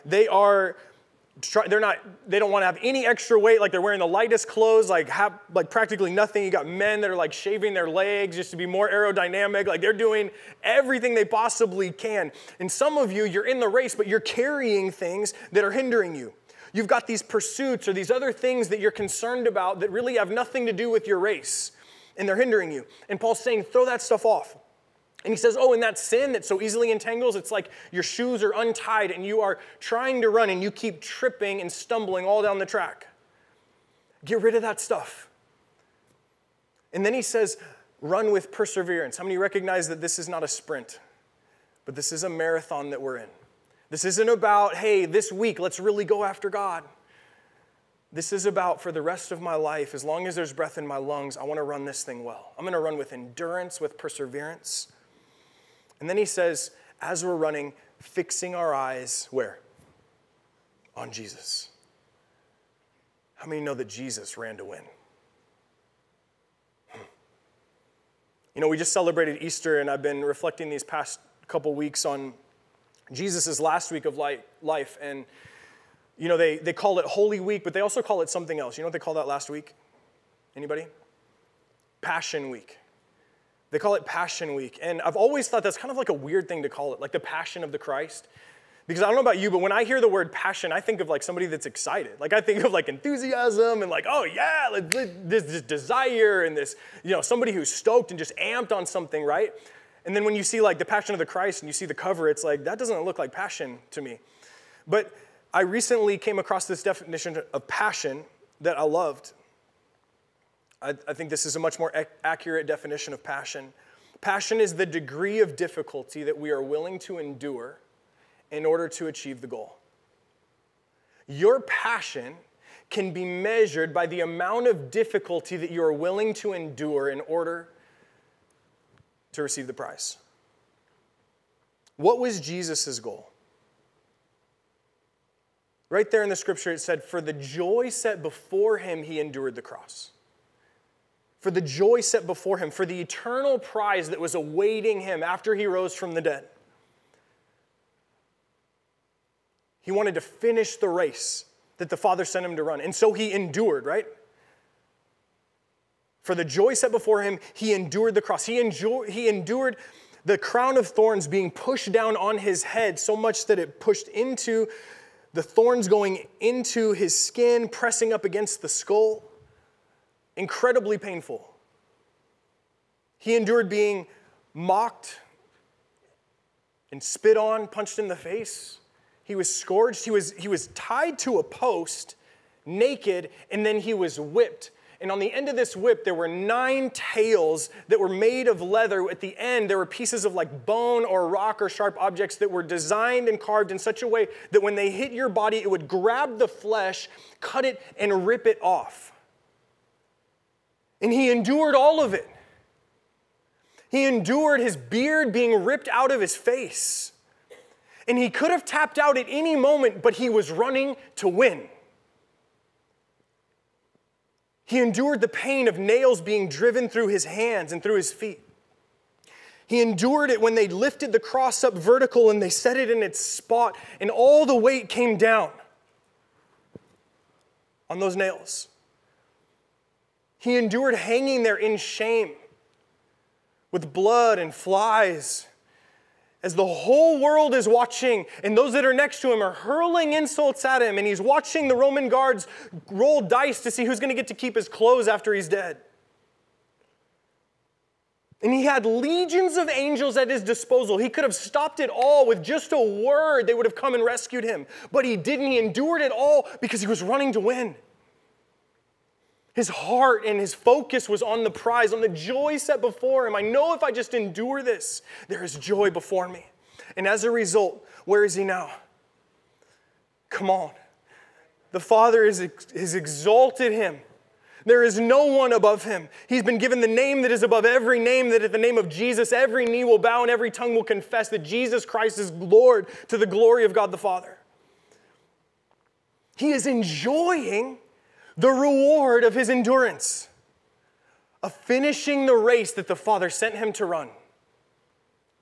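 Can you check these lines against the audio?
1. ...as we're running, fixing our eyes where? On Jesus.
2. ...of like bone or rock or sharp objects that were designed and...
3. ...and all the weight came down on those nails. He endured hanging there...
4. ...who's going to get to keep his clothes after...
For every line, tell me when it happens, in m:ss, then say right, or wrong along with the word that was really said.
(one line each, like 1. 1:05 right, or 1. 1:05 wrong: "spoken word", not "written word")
1. 0:57 right
2. 3:10 right
3. 3:44 right
4. 4:03 right.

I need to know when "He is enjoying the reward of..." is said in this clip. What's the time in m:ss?
4:46.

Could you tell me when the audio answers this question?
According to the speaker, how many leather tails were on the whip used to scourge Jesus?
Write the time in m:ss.
3:06.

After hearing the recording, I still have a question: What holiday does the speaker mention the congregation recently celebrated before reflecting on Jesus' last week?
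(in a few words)
Easter.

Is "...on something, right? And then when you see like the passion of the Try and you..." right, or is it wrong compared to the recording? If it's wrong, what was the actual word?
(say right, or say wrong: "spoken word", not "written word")
wrong: "Christ", not "Try".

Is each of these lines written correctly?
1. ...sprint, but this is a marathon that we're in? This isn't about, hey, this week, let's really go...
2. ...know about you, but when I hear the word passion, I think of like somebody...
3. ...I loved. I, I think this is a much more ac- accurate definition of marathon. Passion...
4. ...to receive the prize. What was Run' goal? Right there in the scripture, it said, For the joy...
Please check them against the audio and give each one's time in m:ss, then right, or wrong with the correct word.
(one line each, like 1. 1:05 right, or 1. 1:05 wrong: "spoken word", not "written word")
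1. 0:40 right
2. 1:29 right
3. 1:48 wrong: "passion", not "marathon"
4. 2:09 wrong: "Jesus", not "Run".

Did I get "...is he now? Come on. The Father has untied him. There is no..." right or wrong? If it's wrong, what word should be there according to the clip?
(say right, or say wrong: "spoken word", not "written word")
wrong: "exalted", not "untied".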